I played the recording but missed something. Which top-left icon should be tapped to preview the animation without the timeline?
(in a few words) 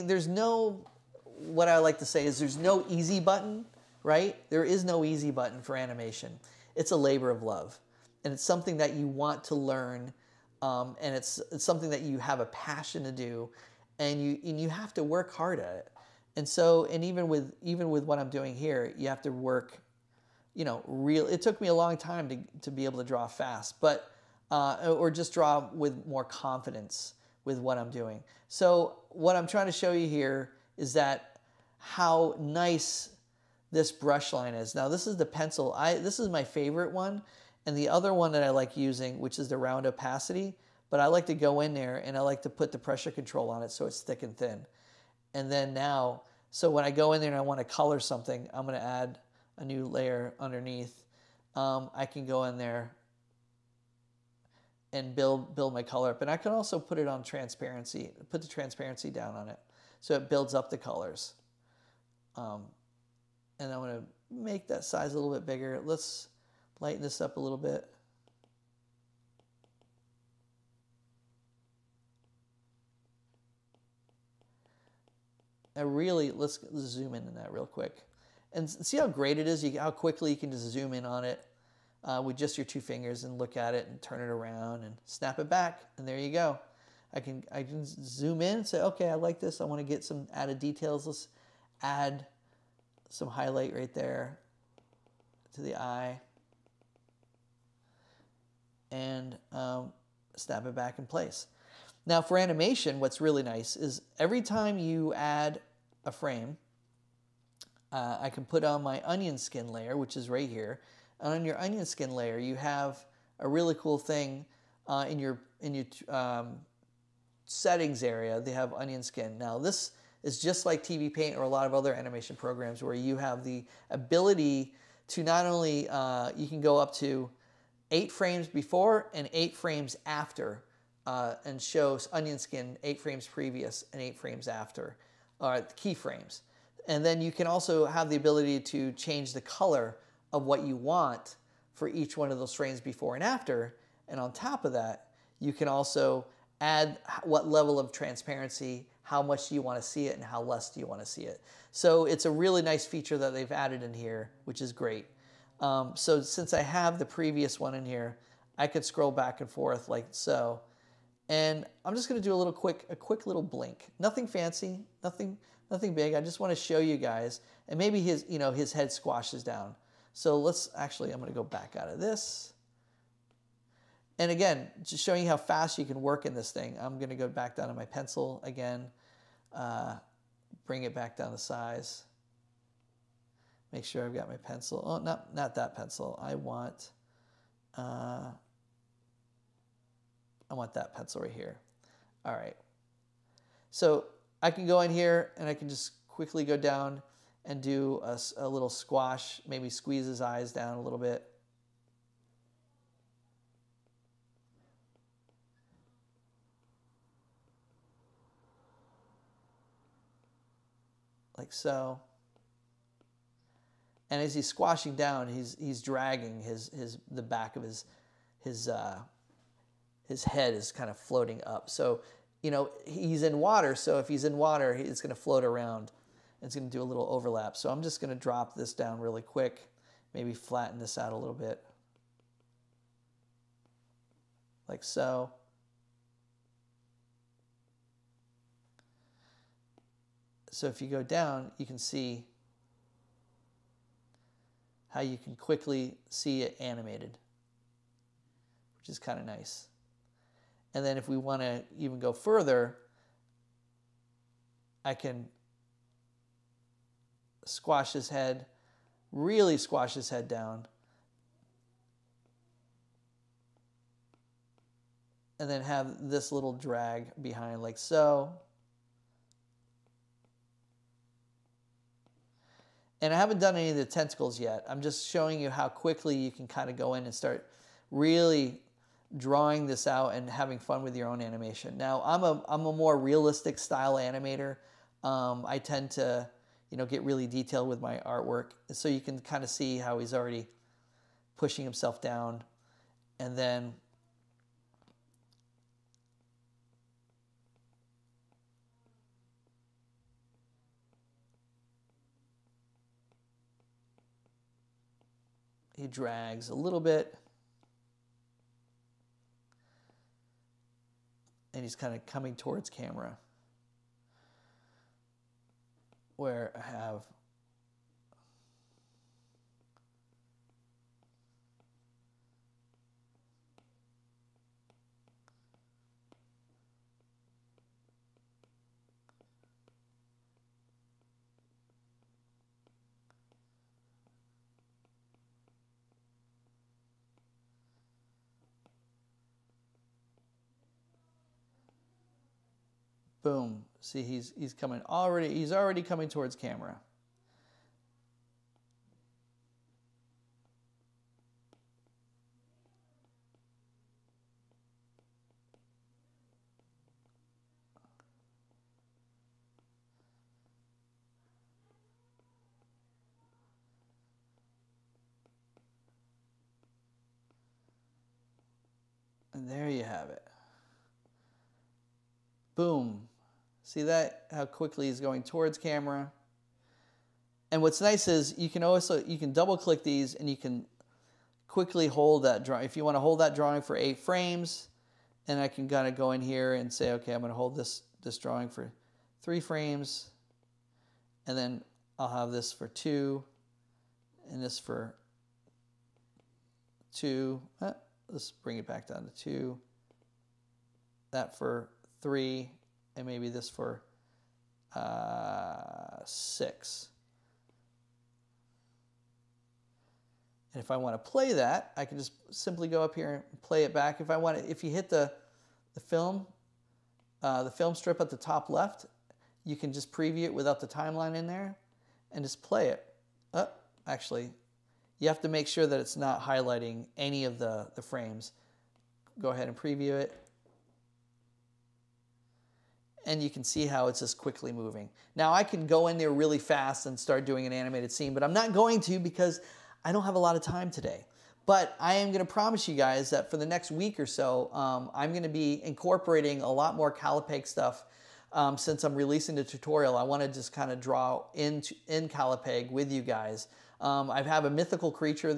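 The film strip.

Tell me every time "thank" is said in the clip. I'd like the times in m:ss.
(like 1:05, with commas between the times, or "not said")
not said.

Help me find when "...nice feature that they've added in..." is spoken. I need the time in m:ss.
2:32.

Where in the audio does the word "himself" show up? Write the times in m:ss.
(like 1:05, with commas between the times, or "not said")
4:51.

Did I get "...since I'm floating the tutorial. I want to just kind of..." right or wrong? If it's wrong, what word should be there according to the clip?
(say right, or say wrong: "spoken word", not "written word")
wrong: "releasing", not "floating".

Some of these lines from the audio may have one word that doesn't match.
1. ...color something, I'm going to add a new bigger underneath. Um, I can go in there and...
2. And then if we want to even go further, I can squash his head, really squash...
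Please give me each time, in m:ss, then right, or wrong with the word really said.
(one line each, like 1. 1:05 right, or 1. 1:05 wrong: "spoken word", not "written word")
1. 0:47 wrong: "layer", not "bigger"
2. 4:10 right.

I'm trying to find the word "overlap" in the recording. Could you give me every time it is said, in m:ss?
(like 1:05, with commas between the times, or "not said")
3:47.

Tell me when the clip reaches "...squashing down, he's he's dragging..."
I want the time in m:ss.
3:34.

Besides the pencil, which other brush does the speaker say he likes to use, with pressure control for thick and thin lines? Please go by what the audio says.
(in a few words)
Round opacity.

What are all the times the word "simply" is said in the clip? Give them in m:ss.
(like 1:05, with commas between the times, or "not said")
6:52.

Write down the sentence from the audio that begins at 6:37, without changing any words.
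Eh, let's bring it back down to two.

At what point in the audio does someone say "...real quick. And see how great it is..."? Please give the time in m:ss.
1:17.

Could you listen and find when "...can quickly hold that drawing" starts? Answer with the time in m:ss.
6:20.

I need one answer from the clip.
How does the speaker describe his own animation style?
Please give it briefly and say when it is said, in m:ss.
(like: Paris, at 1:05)
Realistic, at 4:42.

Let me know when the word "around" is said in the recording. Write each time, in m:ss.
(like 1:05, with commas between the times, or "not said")
1:24, 3:45.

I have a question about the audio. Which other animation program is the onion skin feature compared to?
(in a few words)
TV Paint.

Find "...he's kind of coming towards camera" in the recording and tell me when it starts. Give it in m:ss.
5:11.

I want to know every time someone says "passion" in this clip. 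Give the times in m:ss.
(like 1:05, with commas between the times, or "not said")
0:12.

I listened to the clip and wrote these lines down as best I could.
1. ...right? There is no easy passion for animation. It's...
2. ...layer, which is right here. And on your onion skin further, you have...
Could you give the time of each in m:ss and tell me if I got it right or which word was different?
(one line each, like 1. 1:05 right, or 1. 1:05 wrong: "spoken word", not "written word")
1. 0:04 wrong: "button", not "passion"
2. 1:49 wrong: "layer", not "further".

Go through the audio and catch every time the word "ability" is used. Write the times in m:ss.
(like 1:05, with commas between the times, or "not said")
2:03, 2:18.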